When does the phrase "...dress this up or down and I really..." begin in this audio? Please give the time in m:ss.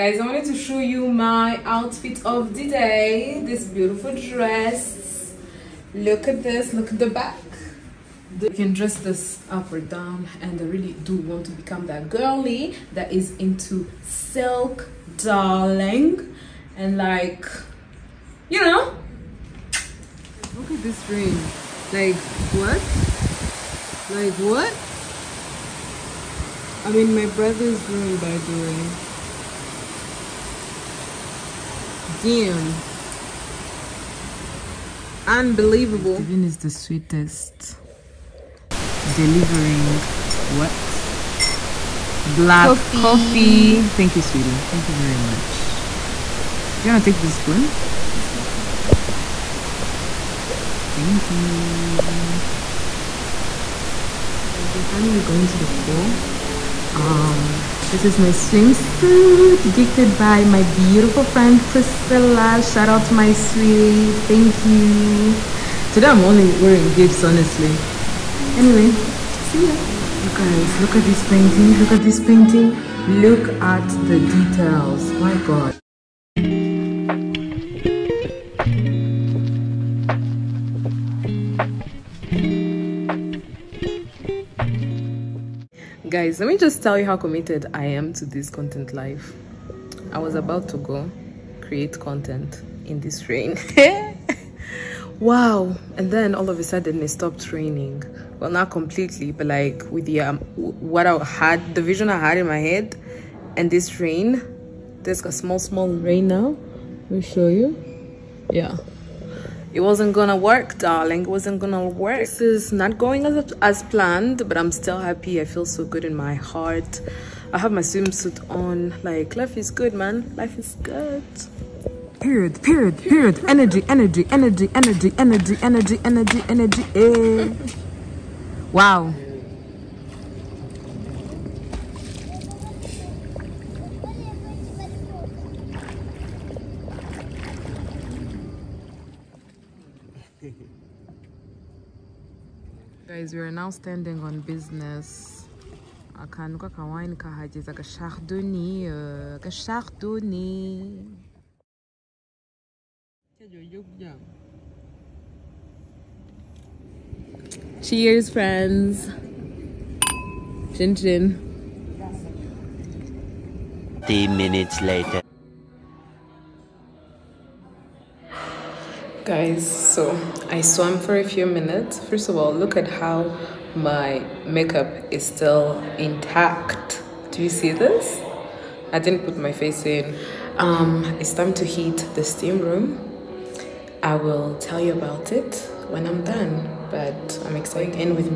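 0:08.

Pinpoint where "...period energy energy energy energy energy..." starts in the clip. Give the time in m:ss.
2:02.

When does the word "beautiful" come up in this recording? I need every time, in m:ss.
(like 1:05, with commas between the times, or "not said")
0:03, 1:00.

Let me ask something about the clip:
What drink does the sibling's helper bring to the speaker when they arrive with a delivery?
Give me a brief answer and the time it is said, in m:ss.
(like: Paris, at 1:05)
Black coffee, at 0:42.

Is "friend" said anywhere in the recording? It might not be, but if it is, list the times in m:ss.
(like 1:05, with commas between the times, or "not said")
1:01, 2:38.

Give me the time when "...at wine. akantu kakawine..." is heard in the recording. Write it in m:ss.
2:26.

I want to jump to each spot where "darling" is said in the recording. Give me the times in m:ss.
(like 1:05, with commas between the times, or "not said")
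0:15, 1:50.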